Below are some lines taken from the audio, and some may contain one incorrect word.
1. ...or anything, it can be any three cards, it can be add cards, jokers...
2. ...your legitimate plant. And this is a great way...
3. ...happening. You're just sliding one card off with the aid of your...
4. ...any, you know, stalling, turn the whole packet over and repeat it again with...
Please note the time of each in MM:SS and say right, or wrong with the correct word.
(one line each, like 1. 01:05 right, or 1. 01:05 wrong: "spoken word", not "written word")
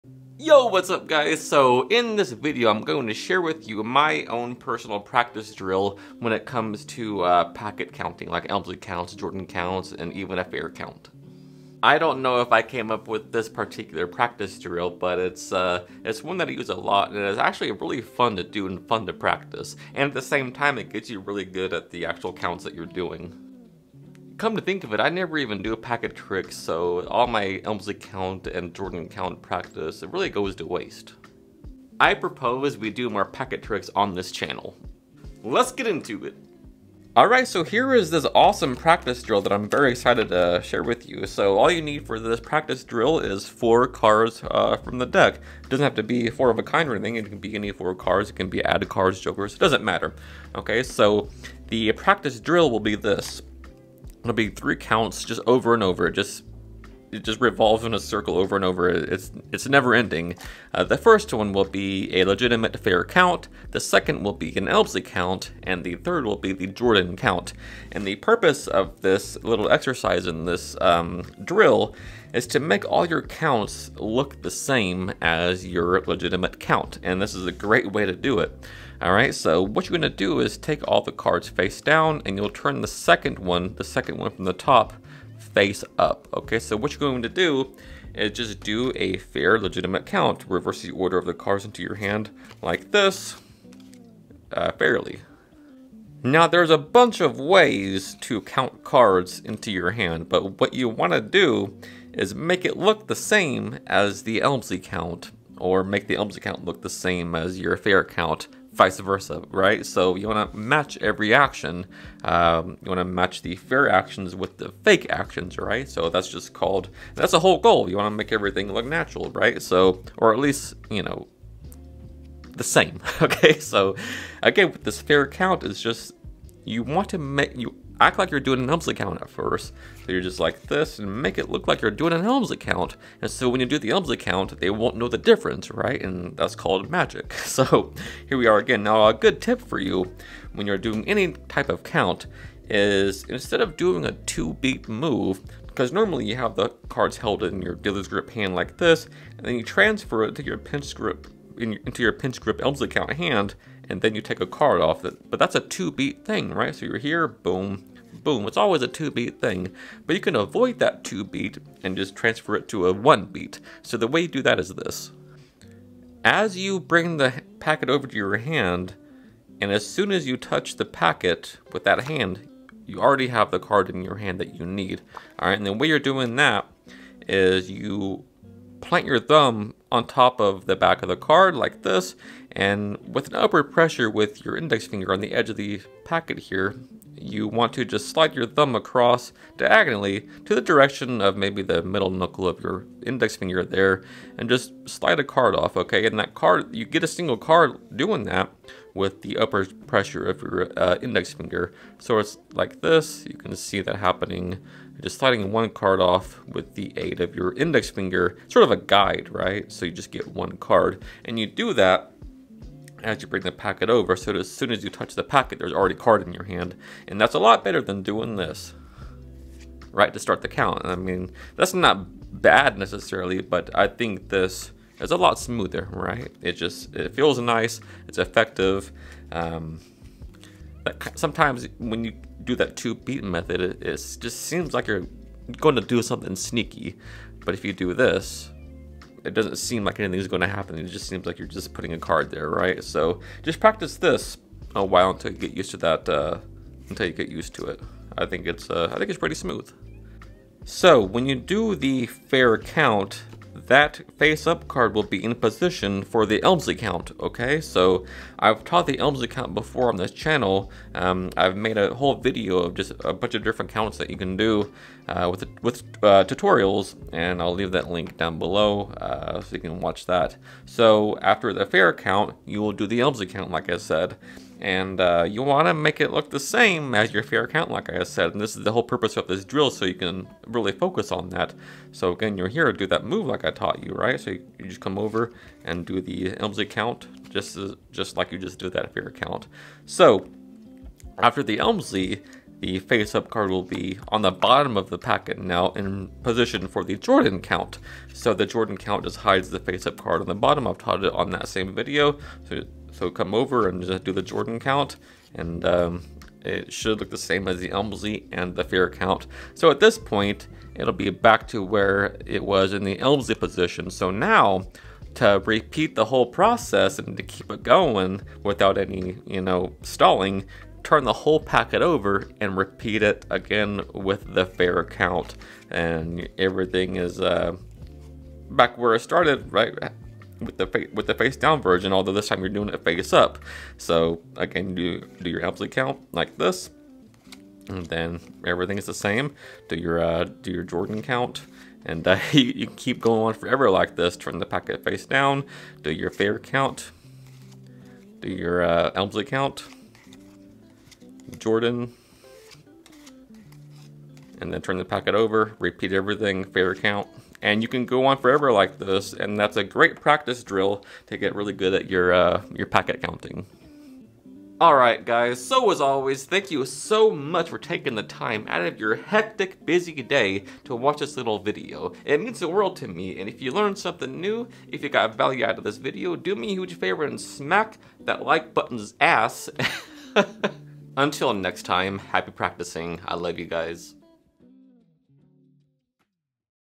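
1. 00:46 wrong: "four", not "three"
2. 01:15 wrong: "count", not "plant"
3. 03:23 right
4. 05:18 right.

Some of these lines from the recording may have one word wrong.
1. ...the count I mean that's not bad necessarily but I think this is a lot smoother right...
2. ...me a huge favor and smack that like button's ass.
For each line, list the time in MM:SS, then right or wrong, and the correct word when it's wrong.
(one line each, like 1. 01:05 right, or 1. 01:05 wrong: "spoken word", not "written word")
1. 03:40 right
2. 06:16 right.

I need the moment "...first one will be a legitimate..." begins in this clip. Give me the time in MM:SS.
01:00.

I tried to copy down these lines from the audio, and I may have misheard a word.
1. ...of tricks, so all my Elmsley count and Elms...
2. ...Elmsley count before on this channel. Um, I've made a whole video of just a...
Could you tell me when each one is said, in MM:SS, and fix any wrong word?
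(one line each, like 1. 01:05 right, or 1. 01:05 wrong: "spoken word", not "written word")
1. 00:26 wrong: "Jordan", not "Elms"
2. 04:18 right.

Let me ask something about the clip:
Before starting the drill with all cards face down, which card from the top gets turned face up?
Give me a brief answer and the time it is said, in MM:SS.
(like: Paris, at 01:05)
the second one, at 01:23.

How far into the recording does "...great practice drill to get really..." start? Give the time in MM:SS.
05:59.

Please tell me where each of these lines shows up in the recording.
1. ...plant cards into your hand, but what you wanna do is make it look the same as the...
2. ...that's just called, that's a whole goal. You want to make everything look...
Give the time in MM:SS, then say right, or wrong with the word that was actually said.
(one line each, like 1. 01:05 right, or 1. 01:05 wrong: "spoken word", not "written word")
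1. 01:38 wrong: "count", not "plant"
2. 01:56 right.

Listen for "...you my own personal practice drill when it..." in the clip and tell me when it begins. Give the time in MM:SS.
00:03.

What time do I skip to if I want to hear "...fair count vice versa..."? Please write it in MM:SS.
01:47.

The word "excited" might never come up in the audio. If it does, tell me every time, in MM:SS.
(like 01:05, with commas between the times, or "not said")
00:39.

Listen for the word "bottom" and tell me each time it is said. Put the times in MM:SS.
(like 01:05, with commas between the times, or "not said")
04:54, 05:00.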